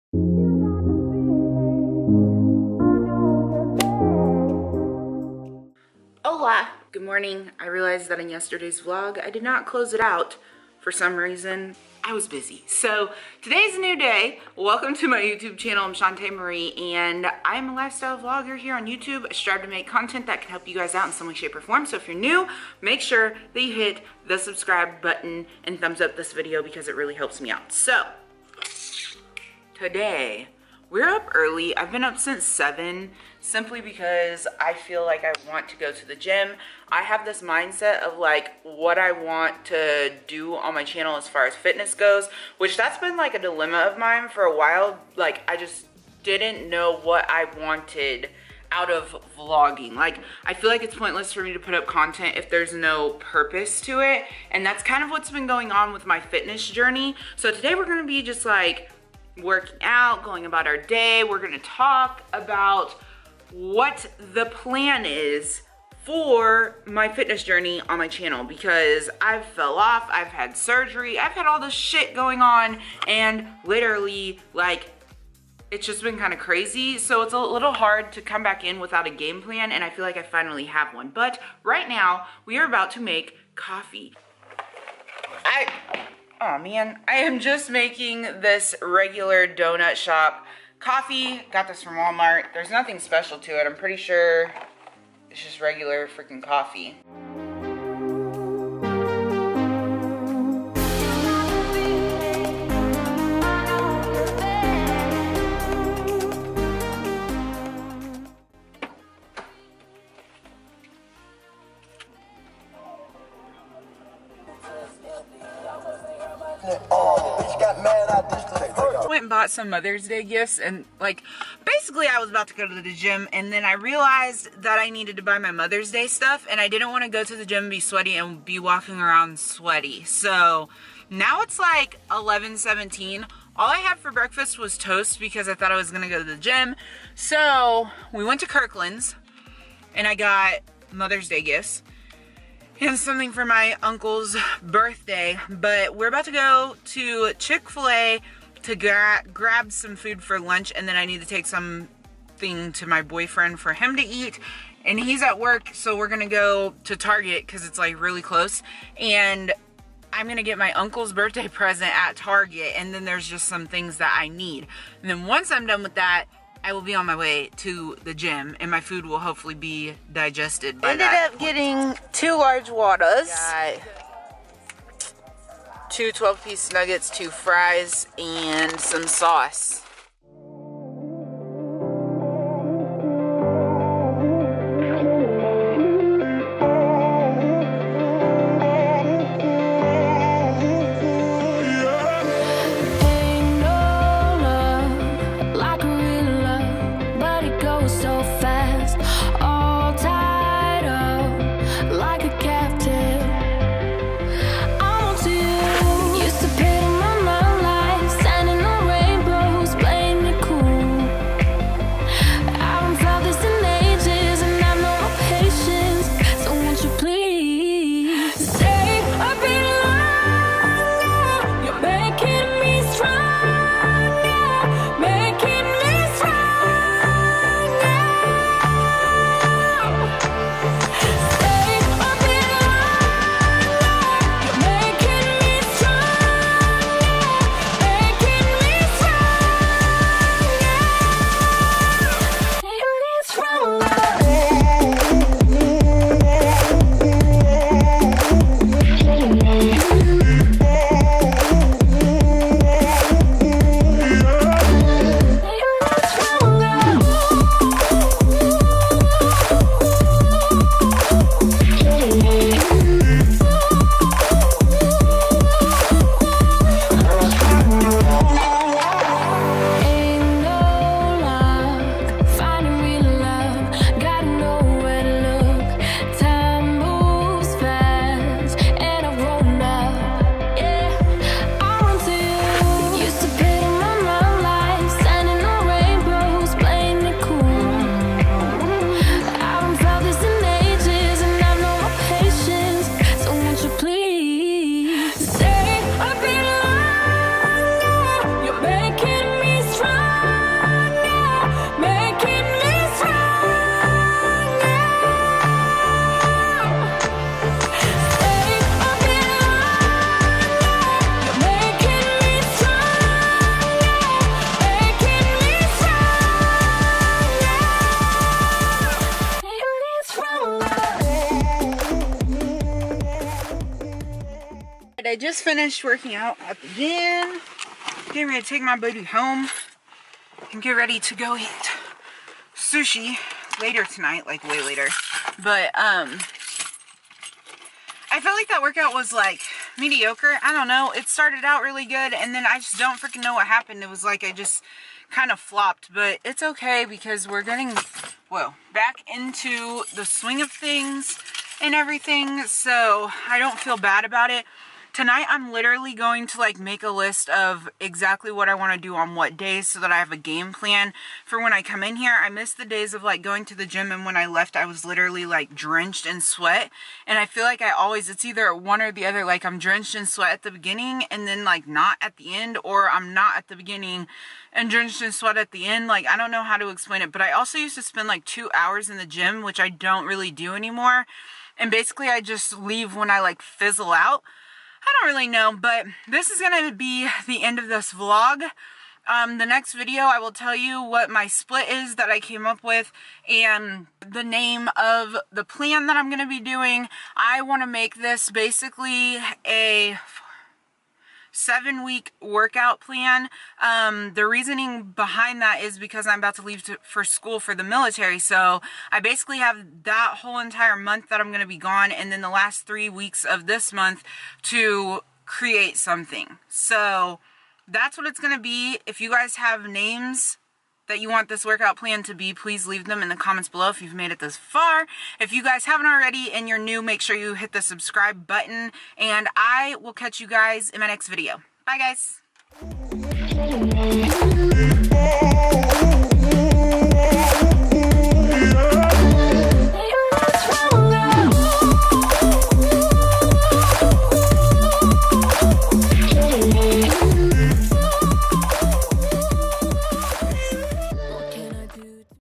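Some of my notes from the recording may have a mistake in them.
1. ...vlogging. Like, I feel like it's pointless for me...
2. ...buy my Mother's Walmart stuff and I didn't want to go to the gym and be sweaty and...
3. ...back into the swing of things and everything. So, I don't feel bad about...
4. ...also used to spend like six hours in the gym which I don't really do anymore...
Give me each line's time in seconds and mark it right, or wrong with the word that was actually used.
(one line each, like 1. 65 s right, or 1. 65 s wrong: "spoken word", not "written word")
1. 49 s right
2. 125 s wrong: "Day", not "Walmart"
3. 348 s right
4. 377 s wrong: "two", not "six".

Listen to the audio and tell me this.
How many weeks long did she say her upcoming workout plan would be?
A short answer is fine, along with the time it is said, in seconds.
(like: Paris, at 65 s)
7, at 401 s.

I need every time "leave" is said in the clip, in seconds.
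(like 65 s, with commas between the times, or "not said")
382 s, 406 s, 422 s.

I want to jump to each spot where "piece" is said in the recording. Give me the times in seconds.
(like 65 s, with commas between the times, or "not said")
176 s.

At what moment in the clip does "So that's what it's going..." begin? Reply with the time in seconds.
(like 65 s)
416 s.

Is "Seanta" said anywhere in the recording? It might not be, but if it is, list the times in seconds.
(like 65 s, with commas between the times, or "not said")
15 s.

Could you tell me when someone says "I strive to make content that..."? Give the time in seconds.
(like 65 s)
19 s.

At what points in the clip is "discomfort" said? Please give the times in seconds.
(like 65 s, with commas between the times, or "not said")
not said.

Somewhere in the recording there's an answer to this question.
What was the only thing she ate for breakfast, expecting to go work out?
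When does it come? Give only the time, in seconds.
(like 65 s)
134 s.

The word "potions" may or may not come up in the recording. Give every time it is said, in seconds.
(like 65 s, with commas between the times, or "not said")
not said.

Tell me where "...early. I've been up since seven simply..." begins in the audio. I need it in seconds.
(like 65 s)
31 s.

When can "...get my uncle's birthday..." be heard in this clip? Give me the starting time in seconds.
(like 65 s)
160 s.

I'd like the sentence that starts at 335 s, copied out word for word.
But um I felt like that workout was like mediocre.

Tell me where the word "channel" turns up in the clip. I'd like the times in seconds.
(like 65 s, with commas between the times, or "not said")
15 s, 40 s, 68 s.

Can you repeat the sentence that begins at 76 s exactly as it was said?
So it's a little hard to come back in without a game plan and I feel like I finally have one.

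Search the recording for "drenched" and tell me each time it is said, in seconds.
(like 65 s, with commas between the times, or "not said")
365 s, 369 s, 374 s.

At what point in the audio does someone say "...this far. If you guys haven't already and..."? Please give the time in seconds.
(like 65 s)
424 s.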